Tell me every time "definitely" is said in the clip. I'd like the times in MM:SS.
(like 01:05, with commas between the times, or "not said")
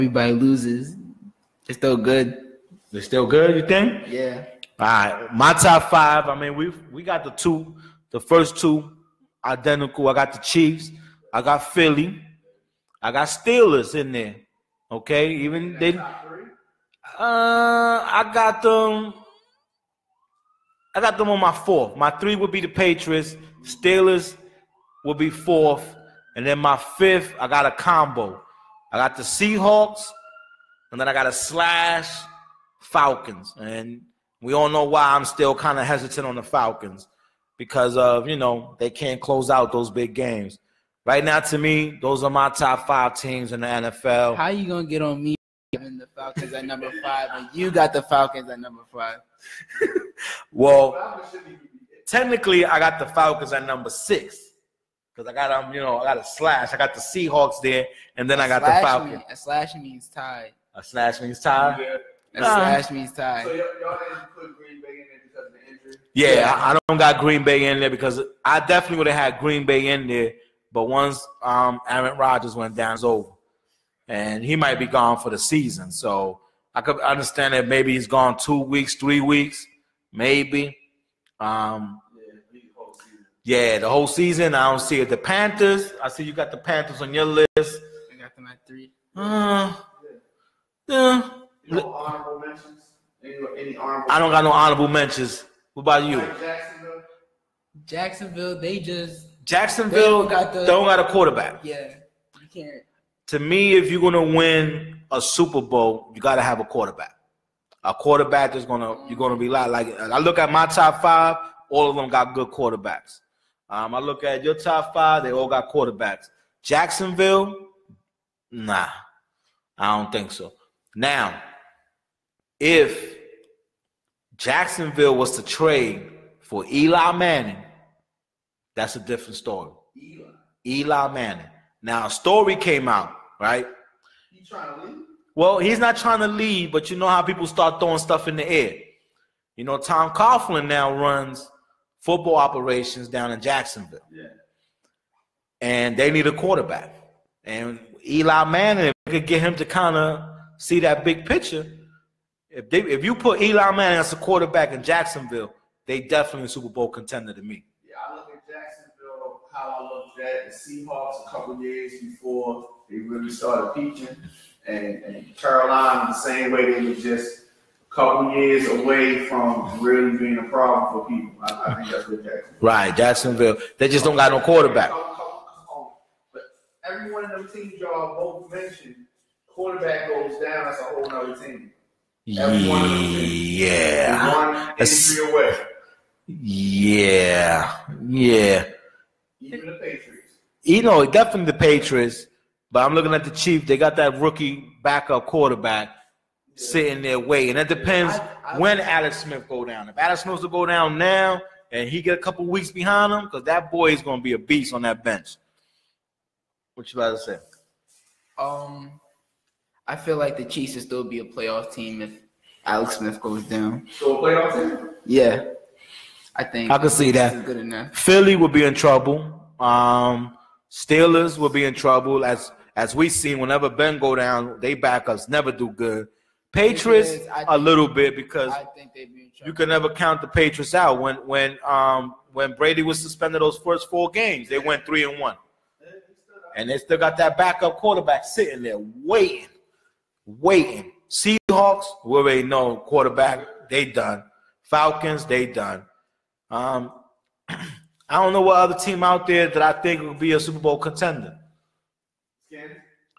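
01:08, 02:36, 03:11.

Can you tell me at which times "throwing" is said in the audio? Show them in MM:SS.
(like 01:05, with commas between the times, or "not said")
02:17.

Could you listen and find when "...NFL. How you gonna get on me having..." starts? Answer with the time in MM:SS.
00:43.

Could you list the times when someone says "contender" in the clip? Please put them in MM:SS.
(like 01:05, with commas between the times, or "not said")
02:36, 04:10.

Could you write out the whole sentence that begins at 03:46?
Patriots is, a little bit because be you can never count the Patriots out.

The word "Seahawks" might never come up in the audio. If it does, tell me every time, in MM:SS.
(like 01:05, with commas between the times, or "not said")
00:29, 00:56, 02:40, 04:01.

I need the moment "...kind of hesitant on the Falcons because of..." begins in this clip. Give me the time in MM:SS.
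00:35.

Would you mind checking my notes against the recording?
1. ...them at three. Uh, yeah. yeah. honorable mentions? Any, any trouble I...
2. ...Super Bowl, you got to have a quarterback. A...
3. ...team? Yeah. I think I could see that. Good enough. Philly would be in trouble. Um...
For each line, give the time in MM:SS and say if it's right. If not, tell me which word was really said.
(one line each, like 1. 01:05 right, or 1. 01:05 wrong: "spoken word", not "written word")
1. 01:28 wrong: "honorable", not "trouble"
2. 01:45 right
3. 03:34 right.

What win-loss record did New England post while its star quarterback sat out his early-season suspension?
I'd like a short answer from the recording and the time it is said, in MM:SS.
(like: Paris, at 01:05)
3 and 1, at 03:54.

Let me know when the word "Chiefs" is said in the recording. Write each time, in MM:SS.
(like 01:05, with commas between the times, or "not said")
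00:10, 03:13, 03:30.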